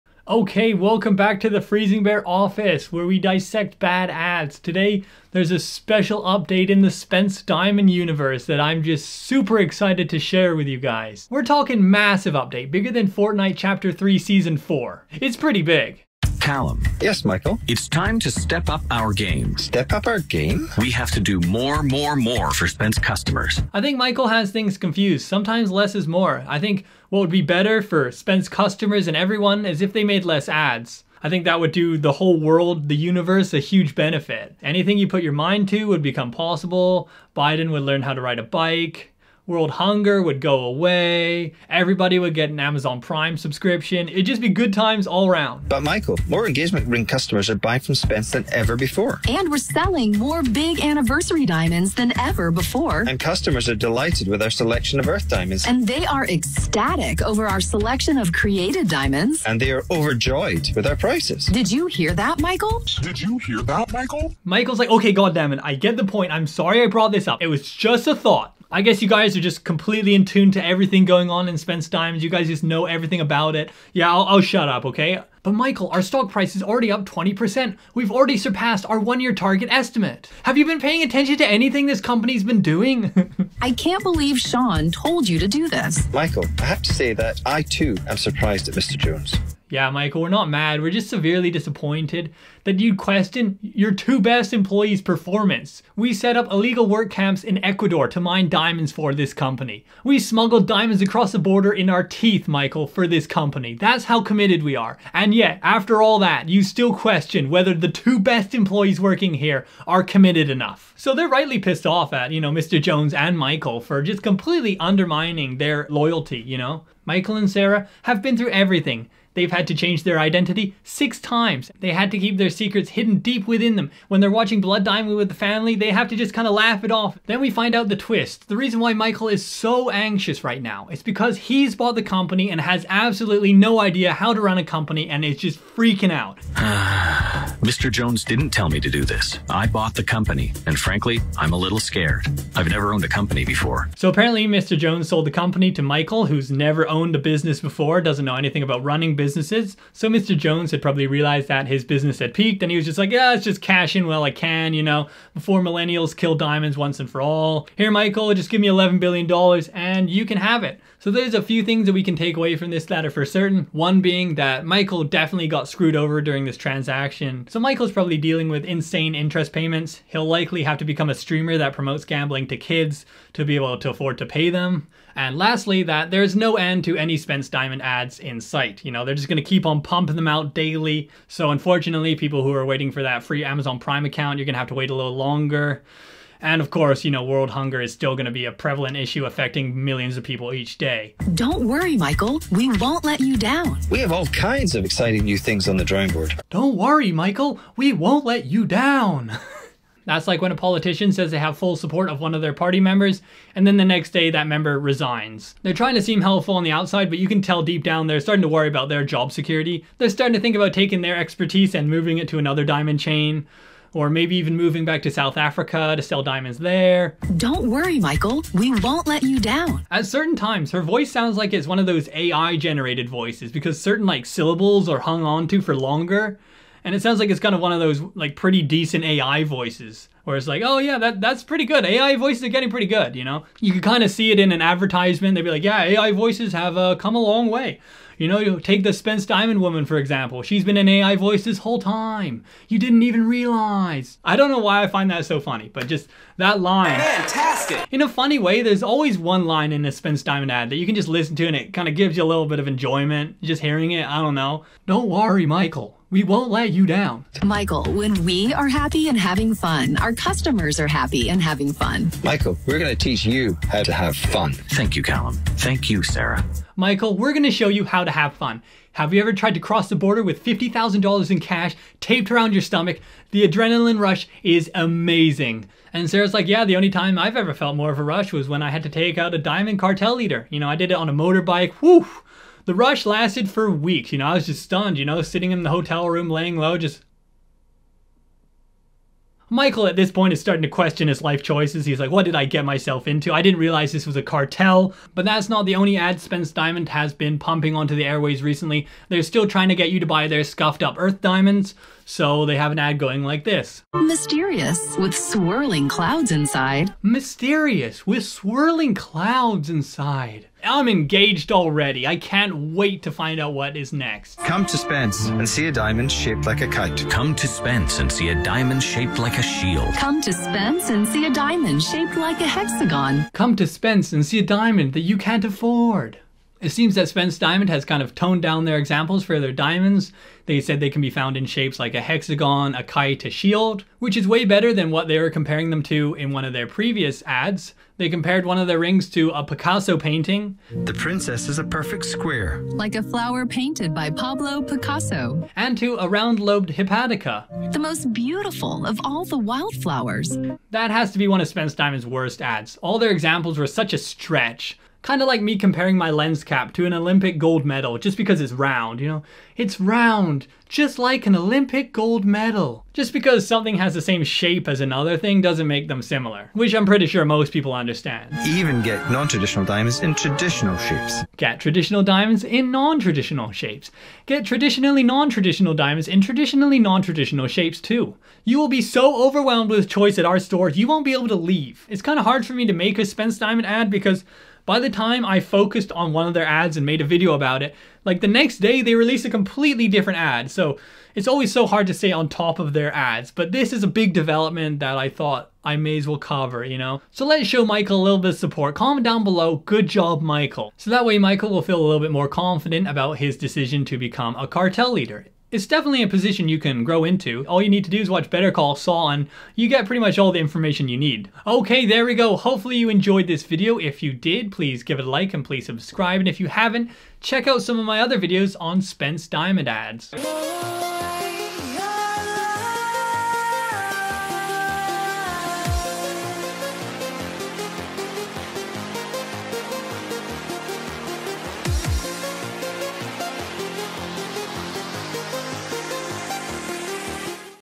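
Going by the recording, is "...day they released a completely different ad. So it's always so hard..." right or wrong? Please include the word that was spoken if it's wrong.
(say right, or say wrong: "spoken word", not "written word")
right.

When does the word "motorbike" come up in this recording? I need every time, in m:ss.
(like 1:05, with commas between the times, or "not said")
4:41.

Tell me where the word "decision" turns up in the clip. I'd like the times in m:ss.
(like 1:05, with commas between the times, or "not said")
6:43.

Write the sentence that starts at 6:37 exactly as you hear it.
So let's show Michael a little bit of support.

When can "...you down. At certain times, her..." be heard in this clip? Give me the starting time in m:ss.
3:39.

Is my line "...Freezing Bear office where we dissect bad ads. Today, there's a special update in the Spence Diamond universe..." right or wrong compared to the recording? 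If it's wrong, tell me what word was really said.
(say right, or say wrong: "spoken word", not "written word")
right.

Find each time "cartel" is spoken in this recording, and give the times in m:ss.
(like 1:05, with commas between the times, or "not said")
4:39, 4:54, 6:44.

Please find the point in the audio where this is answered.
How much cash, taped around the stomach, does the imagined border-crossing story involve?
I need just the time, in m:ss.
4:30.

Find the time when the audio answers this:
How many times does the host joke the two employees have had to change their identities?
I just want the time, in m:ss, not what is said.
2:00.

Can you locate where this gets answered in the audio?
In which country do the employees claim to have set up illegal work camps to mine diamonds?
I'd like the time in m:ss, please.
1:37.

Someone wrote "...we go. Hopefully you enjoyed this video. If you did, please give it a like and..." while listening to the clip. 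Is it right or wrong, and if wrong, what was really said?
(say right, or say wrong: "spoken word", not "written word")
right.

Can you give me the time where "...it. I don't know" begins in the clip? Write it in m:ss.
4:13.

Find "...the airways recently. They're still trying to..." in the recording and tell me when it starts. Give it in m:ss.
4:57.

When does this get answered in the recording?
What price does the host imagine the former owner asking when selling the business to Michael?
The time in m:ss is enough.
2:38.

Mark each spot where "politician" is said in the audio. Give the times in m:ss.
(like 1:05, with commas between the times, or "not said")
3:20.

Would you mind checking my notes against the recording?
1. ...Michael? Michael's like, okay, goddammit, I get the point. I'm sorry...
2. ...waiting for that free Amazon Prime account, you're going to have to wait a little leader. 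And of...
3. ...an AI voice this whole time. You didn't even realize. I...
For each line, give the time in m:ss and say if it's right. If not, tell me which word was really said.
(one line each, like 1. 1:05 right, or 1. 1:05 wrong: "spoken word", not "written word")
1. 1:03 right
2. 3:02 wrong: "longer", not "leader"
3. 4:00 right.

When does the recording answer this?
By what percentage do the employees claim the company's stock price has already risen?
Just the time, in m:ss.
1:17.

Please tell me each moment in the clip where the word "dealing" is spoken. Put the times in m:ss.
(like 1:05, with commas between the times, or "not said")
2:48.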